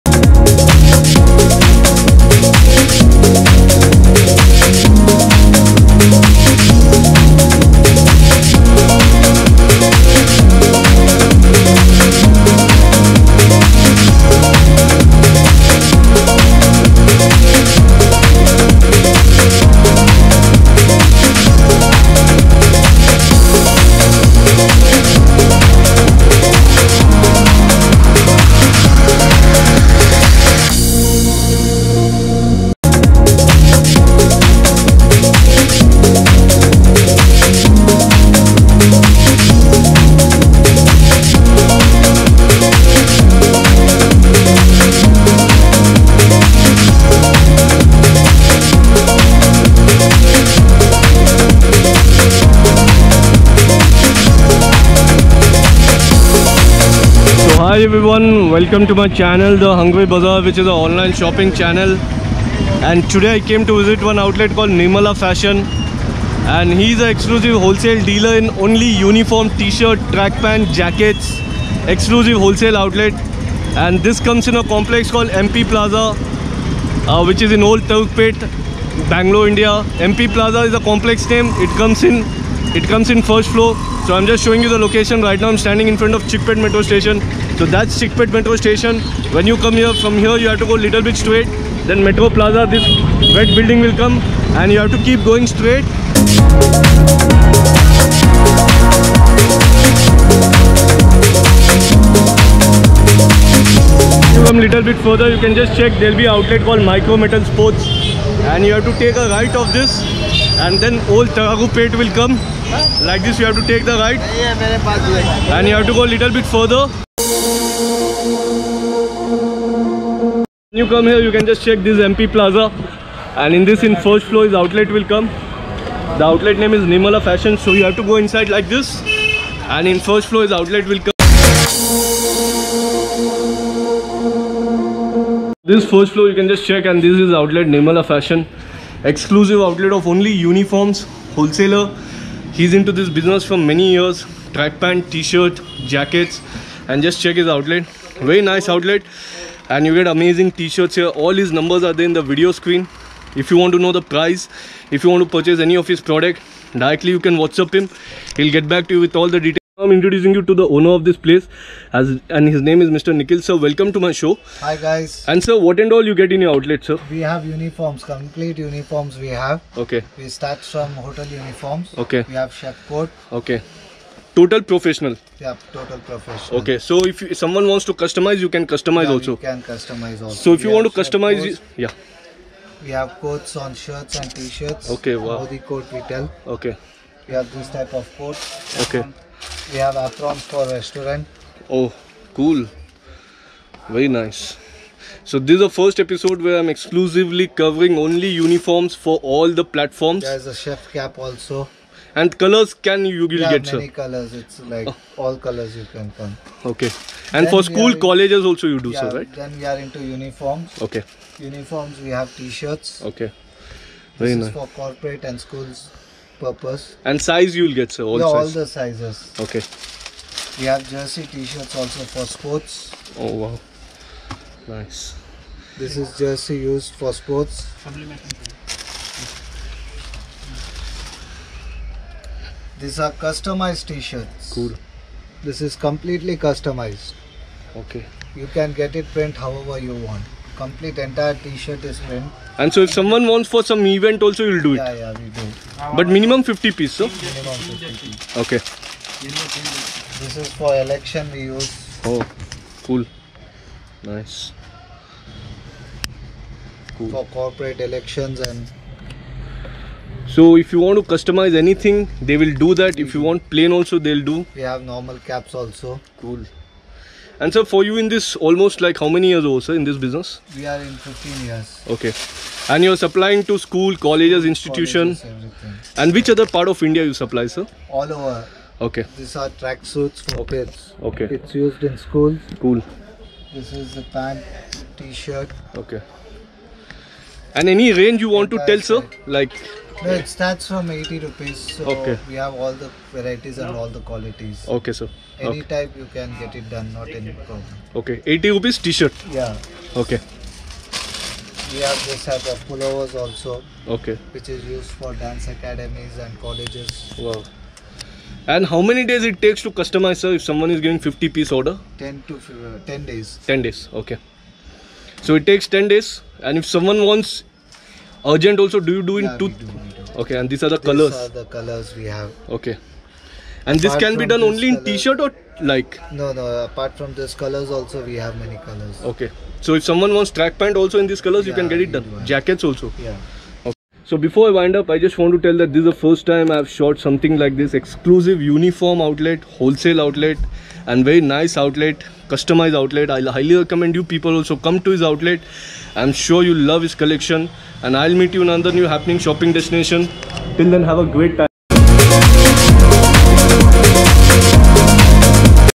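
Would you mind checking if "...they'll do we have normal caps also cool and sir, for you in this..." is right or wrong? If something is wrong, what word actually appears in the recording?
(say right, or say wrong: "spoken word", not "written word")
right.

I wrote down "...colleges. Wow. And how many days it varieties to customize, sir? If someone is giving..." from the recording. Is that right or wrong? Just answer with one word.
wrong.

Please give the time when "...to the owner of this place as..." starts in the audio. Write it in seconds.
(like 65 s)
160 s.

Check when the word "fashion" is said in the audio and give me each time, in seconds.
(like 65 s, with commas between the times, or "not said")
65 s, 127 s, 138 s.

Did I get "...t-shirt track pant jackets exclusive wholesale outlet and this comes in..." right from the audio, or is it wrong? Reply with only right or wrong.
right.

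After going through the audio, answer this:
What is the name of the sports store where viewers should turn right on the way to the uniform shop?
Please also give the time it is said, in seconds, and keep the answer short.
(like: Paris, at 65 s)
Micro Metal Sports, at 106 s.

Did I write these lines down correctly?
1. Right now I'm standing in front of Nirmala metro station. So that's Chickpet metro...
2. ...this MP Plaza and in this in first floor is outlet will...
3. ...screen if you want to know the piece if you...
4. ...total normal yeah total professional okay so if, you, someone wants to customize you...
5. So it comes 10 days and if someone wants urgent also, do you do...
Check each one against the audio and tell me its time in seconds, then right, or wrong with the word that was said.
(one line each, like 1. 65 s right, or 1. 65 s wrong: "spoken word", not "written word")
1. 85 s wrong: "Chickpet", not "Nirmala"
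2. 121 s right
3. 152 s wrong: "price", not "piece"
4. 174 s wrong: "professional", not "normal"
5. 315 s wrong: "takes", not "comes".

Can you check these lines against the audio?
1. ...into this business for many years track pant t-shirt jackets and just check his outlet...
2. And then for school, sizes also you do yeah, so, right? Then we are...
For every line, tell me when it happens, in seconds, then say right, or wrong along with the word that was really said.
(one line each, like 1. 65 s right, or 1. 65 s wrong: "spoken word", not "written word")
1. 142 s right
2. 207 s wrong: "colleges", not "sizes".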